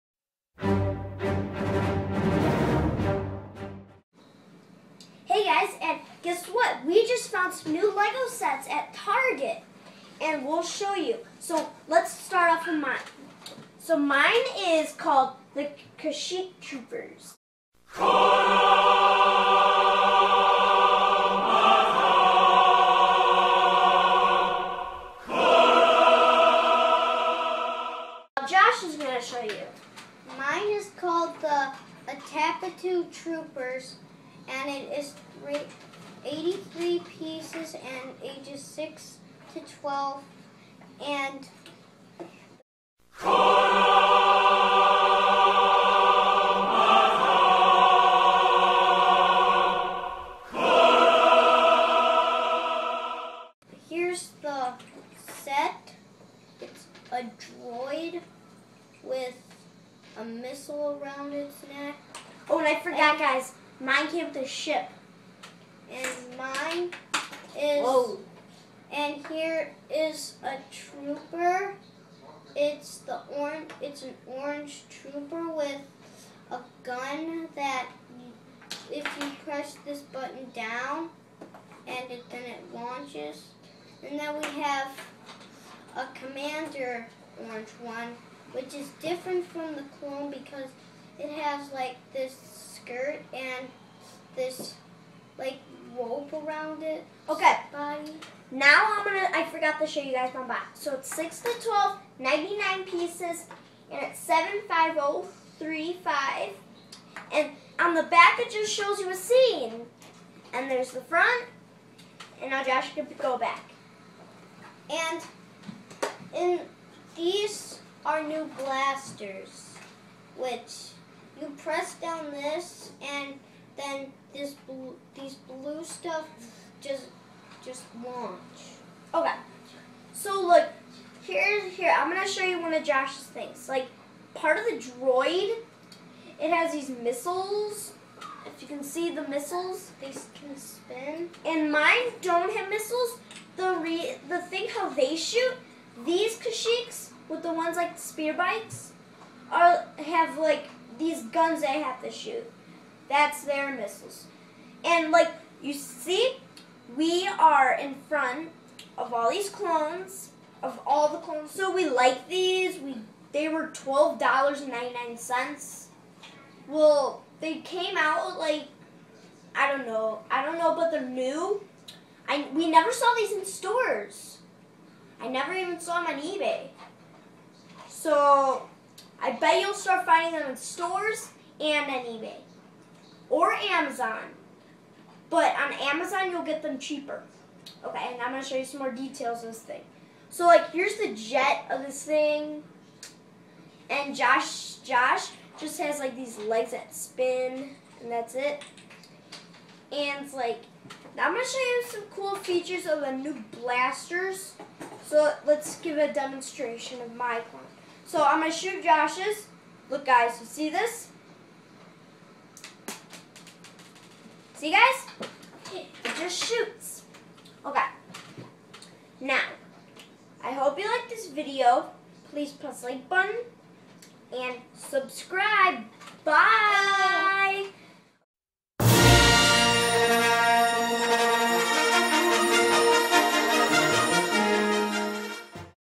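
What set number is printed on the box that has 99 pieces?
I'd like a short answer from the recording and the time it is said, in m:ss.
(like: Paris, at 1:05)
75035, at 1:44.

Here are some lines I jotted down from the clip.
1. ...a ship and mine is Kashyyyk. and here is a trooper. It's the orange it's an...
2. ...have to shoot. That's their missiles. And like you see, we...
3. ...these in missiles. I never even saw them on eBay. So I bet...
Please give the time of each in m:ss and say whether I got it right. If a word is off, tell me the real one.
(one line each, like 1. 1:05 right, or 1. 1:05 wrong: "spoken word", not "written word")
1. 1:04 wrong: "Whoa", not "Kashyyyk"
2. 2:31 right
3. 2:53 wrong: "stores", not "missiles".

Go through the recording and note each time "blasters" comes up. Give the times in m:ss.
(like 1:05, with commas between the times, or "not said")
1:58, 3:23.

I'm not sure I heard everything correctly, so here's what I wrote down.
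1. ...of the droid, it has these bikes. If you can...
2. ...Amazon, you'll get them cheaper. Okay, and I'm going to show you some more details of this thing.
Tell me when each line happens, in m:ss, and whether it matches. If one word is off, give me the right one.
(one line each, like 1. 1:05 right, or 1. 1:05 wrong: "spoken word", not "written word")
1. 2:14 wrong: "missiles", not "bikes"
2. 3:05 right.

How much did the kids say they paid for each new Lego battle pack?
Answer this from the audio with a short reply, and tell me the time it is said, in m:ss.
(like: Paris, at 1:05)
$12.99, at 2:43.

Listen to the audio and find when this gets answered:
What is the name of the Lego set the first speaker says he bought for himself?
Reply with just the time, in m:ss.
0:15.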